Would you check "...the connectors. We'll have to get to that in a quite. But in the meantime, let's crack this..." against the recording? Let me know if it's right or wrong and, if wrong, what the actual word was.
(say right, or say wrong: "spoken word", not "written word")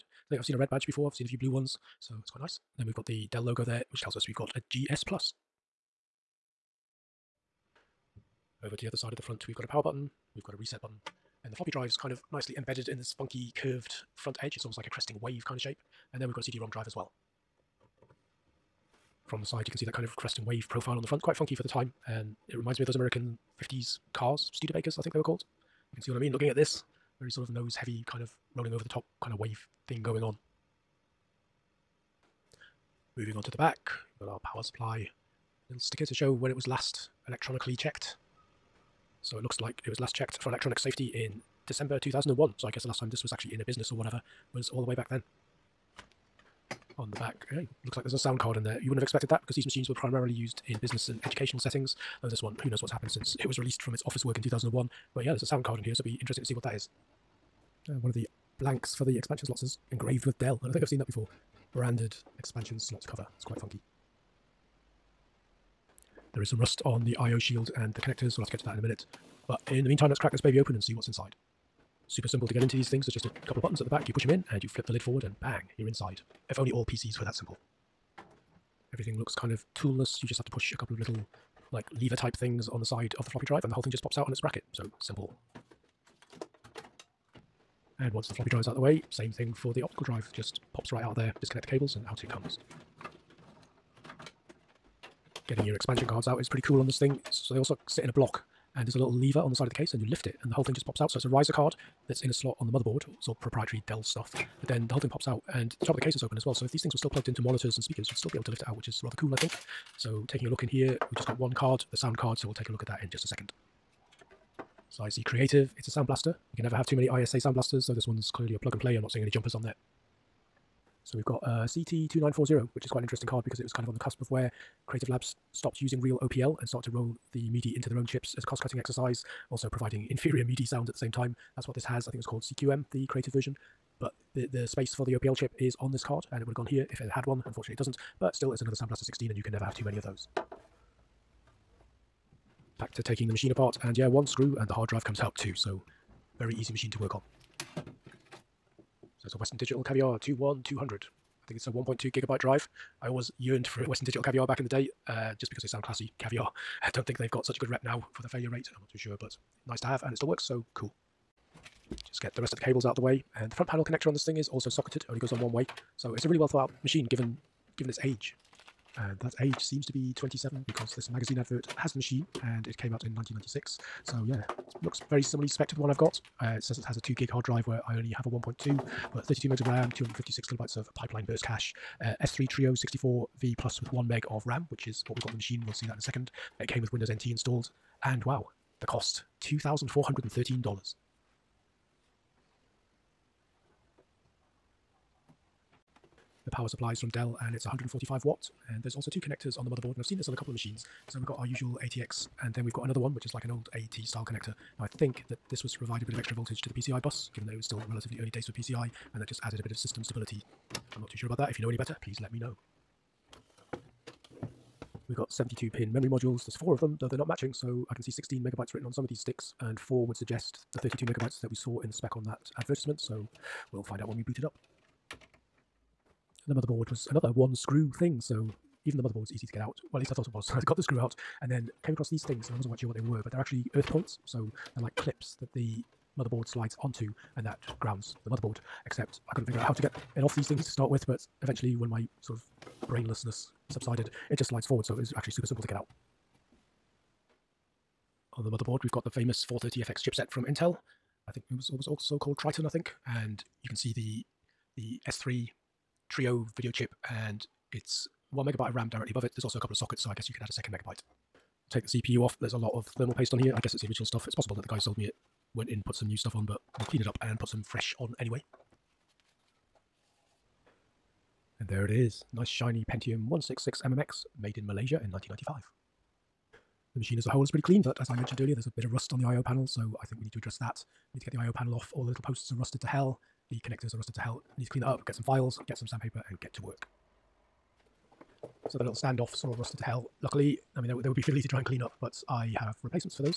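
wrong: "minute", not "quite".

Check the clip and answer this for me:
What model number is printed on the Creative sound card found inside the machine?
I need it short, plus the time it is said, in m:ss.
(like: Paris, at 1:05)
CT2940, at 2:01.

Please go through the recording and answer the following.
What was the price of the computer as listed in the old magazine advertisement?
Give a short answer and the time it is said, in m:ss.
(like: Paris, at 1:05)
$2,413, at 3:09.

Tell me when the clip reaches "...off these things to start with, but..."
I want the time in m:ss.
4:00.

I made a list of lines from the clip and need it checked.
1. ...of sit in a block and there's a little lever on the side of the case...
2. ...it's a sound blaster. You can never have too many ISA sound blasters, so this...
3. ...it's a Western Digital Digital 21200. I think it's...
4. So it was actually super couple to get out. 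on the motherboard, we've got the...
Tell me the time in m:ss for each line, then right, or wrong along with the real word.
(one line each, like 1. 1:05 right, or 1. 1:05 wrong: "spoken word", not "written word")
1. 1:37 right
2. 1:55 right
3. 2:29 wrong: "Caviar", not "Digital"
4. 4:04 wrong: "simple", not "couple".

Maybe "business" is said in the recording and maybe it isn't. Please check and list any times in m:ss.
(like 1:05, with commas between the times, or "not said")
0:43, 0:50.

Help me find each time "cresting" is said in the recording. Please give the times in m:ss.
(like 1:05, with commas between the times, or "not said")
0:14, 0:20.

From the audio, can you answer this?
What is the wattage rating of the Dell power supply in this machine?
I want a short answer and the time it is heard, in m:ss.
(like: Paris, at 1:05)
145 watts, at 3:17.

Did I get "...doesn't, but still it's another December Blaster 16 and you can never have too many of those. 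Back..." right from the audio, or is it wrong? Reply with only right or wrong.
wrong.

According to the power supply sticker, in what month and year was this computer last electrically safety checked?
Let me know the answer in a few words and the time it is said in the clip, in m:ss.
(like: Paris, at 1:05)
December 2001, at 0:41.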